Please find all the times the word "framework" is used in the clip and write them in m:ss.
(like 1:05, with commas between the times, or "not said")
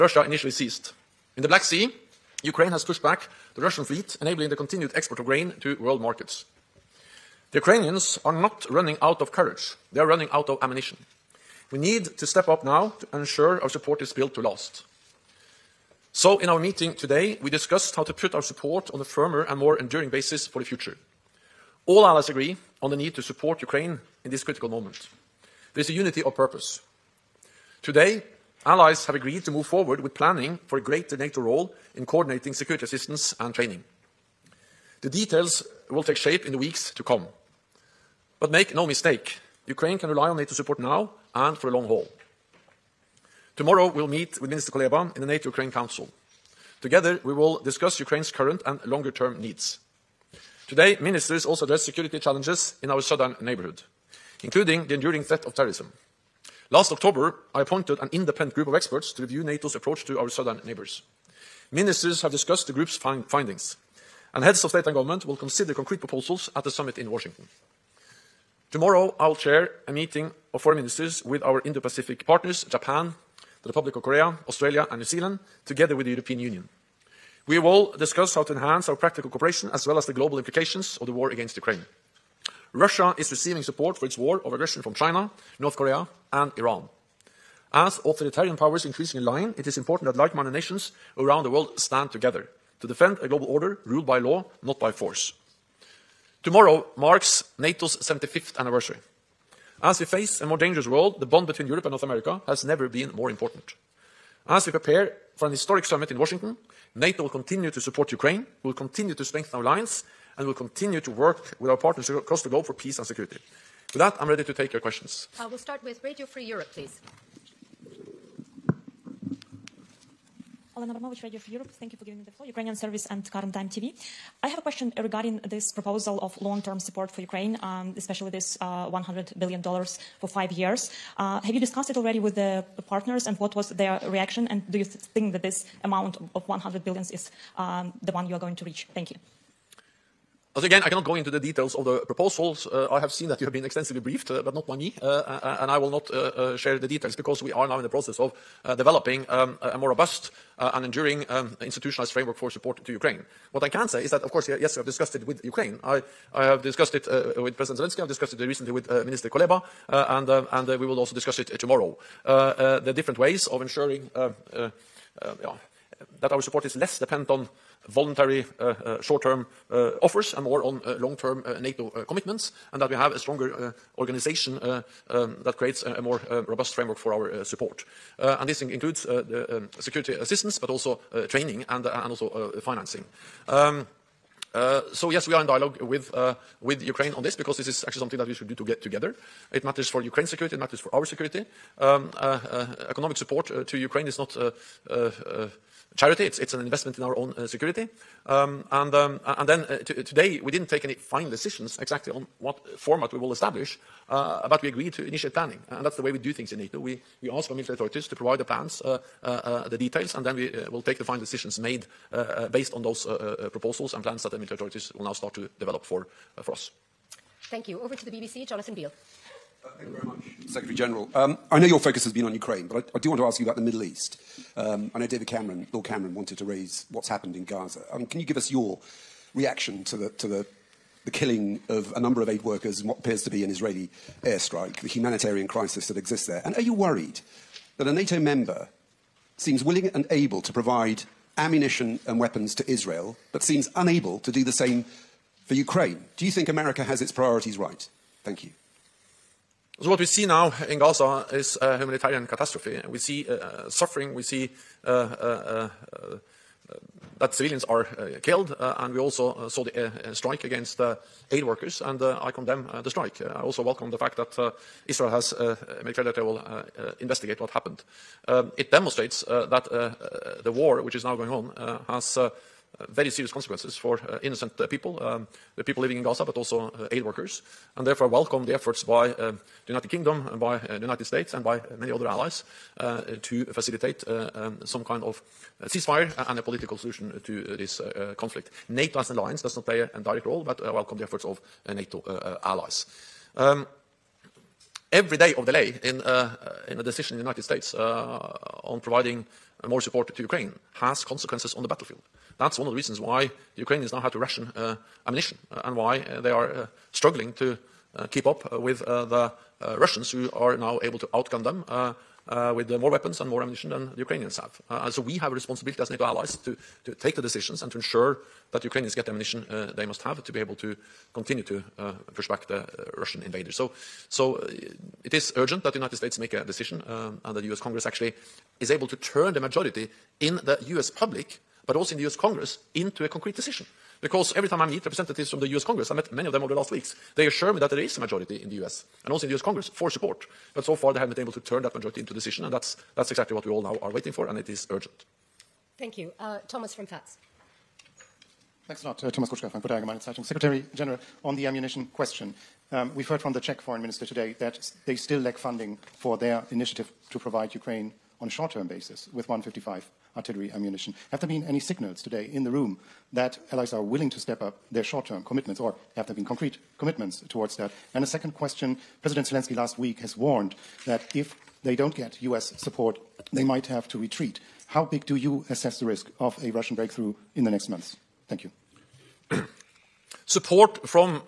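2:32, 2:56.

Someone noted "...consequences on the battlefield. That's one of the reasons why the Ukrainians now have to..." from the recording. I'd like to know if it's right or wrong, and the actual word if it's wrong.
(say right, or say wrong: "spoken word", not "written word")
right.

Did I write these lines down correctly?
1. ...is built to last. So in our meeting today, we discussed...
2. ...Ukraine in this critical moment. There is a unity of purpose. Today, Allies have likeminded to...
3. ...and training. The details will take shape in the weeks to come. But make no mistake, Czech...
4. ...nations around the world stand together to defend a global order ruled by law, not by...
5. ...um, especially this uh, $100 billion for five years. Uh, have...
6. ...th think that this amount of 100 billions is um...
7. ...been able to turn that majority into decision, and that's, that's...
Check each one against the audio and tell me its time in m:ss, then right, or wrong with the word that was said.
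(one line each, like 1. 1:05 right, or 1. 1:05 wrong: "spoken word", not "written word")
1. 0:14 right
2. 0:23 wrong: "agreed", not "likeminded"
3. 0:33 wrong: "Ukraine", not "Czech"
4. 1:30 right
5. 2:07 right
6. 2:14 right
7. 5:41 right.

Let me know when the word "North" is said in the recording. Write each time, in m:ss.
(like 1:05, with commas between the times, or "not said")
1:25, 1:41.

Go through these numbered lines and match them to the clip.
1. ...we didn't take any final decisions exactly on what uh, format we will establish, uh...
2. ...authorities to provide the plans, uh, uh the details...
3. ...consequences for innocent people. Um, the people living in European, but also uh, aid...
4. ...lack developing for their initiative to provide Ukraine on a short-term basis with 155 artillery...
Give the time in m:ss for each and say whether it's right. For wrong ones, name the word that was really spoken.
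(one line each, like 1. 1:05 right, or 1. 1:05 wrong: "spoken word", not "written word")
1. 3:20 right
2. 3:27 right
3. 4:33 wrong: "Gaza", not "European"
4. 5:55 wrong: "funding", not "developing".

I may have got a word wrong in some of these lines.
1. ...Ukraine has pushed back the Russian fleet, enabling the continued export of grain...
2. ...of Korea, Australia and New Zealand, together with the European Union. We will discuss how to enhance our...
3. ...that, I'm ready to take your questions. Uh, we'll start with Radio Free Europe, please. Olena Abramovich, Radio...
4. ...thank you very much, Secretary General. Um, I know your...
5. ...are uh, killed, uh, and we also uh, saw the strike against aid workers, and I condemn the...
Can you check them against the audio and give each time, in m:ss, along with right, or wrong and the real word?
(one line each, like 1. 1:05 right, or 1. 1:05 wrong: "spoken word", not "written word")
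1. 0:02 right
2. 1:13 right
3. 1:53 right
4. 3:39 right
5. 4:17 right.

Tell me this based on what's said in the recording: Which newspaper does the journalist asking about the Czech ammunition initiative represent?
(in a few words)
Frankfurter Allgemeine Zeitung.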